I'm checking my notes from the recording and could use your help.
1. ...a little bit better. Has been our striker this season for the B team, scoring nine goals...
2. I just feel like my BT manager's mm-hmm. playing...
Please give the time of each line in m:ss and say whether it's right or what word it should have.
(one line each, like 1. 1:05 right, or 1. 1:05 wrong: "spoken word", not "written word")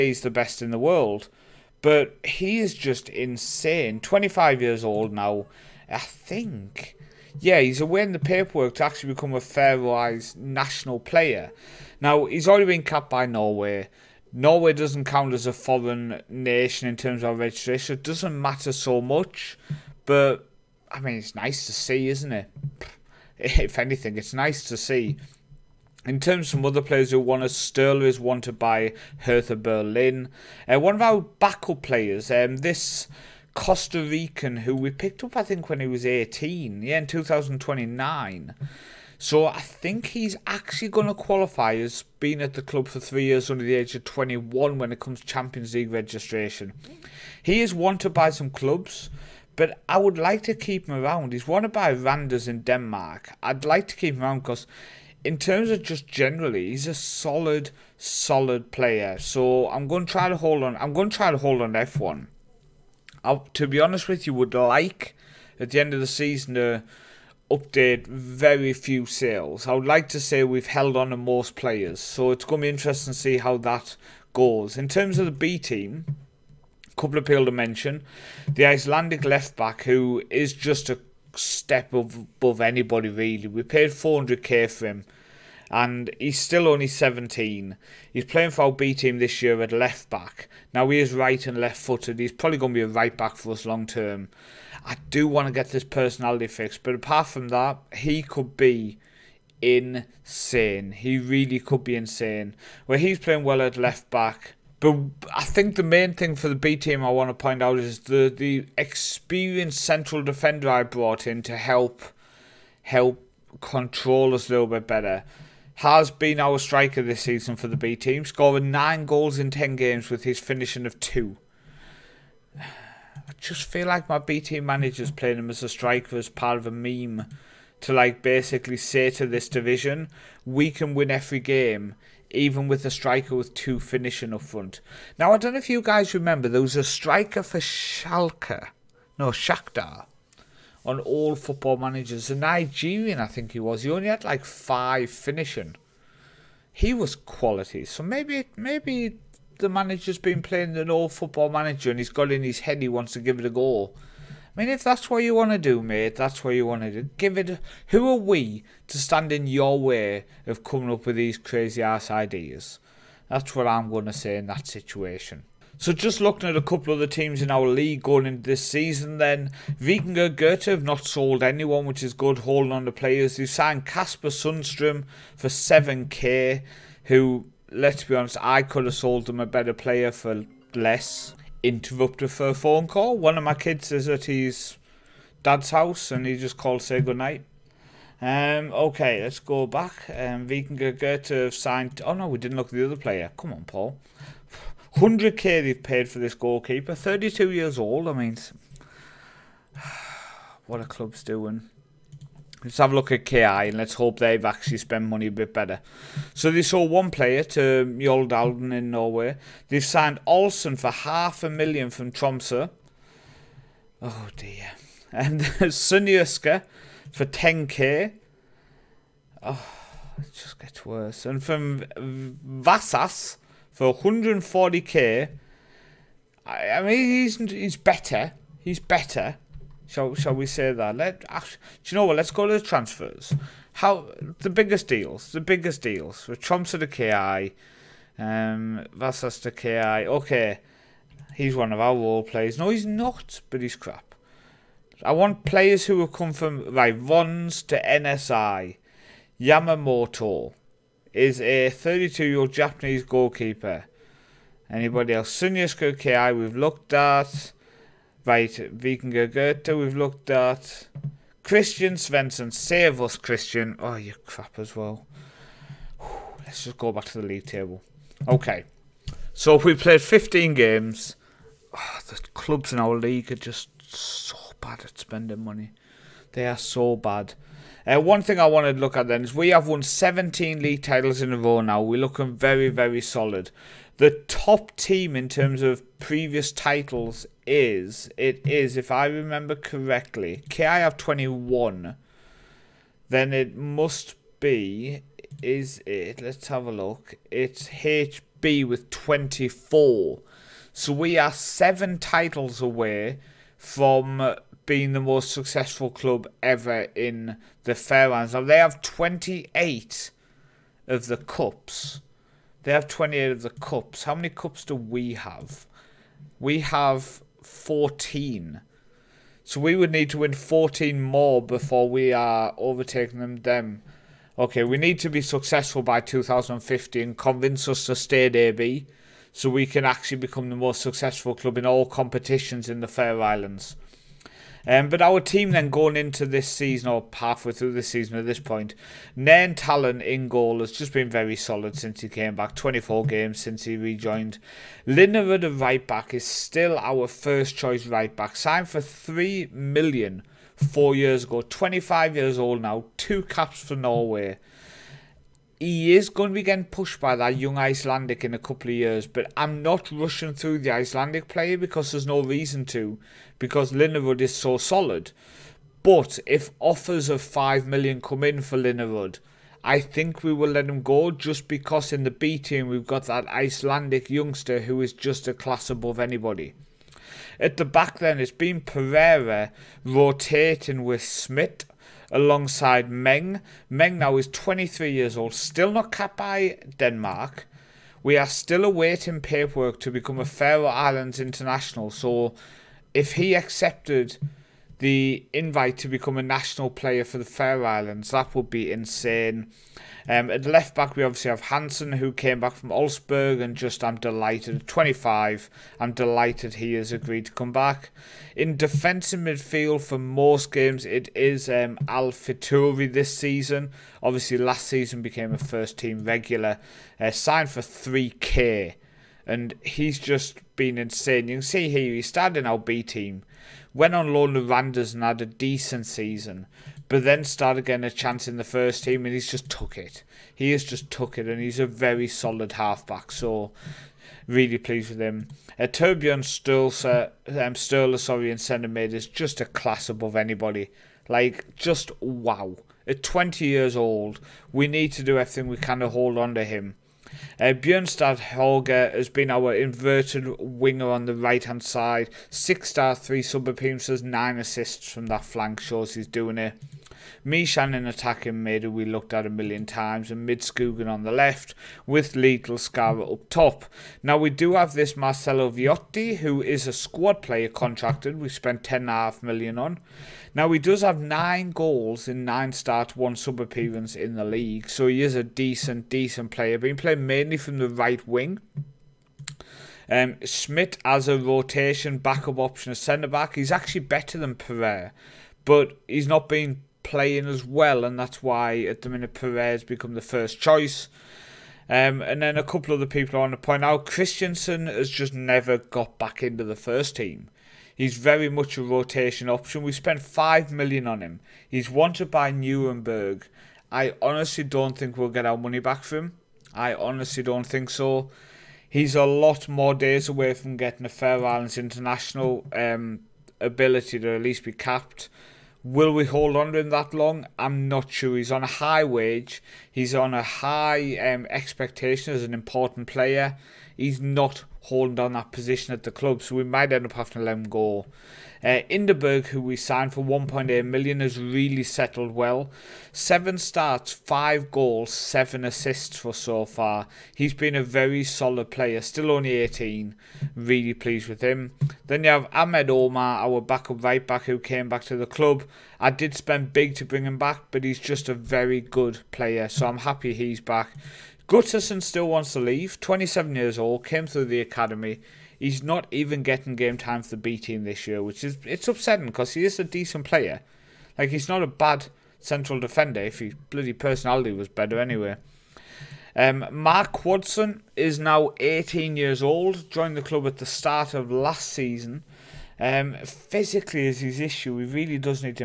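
1. 1:54 right
2. 2:03 right.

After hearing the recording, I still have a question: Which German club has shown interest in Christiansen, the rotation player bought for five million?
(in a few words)
Nuremberg.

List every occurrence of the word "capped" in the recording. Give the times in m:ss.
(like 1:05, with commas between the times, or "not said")
0:12, 6:25, 8:34.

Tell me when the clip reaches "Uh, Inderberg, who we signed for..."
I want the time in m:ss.
8:48.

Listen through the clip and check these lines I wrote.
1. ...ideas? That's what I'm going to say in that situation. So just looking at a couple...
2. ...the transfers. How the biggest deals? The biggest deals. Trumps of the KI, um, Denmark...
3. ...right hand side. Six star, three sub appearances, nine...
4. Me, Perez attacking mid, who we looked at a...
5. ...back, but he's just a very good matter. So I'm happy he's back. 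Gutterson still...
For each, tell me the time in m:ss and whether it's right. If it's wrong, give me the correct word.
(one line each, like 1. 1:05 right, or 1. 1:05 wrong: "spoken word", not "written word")
1. 2:42 right
2. 3:52 wrong: "Vasas", not "Denmark"
3. 7:31 right
4. 7:37 wrong: "Shannon", not "Perez"
5. 9:07 wrong: "player", not "matter".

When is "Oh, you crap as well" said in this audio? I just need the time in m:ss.
4:23.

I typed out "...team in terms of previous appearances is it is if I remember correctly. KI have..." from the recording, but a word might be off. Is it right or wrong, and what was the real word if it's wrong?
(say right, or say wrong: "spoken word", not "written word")
wrong: "titles", not "appearances".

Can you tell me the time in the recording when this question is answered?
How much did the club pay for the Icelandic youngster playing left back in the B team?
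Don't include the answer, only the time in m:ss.
1:23.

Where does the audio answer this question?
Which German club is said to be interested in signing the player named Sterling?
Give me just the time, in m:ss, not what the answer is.
0:29.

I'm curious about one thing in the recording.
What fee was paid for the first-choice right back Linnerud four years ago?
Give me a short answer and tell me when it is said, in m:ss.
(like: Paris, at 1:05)
3 million, at 5:48.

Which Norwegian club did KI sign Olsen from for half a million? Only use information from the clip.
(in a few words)
Tromsø.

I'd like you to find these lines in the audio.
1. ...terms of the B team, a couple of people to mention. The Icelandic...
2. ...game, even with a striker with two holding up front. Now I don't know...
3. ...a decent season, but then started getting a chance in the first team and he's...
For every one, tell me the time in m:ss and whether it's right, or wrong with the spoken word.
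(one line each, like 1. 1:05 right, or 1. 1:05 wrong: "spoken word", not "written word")
1. 1:14 right
2. 2:11 wrong: "finishing", not "holding"
3. 7:05 right.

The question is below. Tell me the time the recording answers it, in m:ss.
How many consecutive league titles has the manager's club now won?
4:39.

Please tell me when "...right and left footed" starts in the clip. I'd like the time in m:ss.
1:31.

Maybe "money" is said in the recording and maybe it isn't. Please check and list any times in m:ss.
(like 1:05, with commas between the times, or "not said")
3:25, 4:35, 8:25.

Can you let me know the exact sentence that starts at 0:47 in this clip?
He is wanted by some clubs, but I would like to keep him around.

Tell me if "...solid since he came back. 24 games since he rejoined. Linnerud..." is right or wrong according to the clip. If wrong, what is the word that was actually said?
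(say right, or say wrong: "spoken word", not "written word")
right.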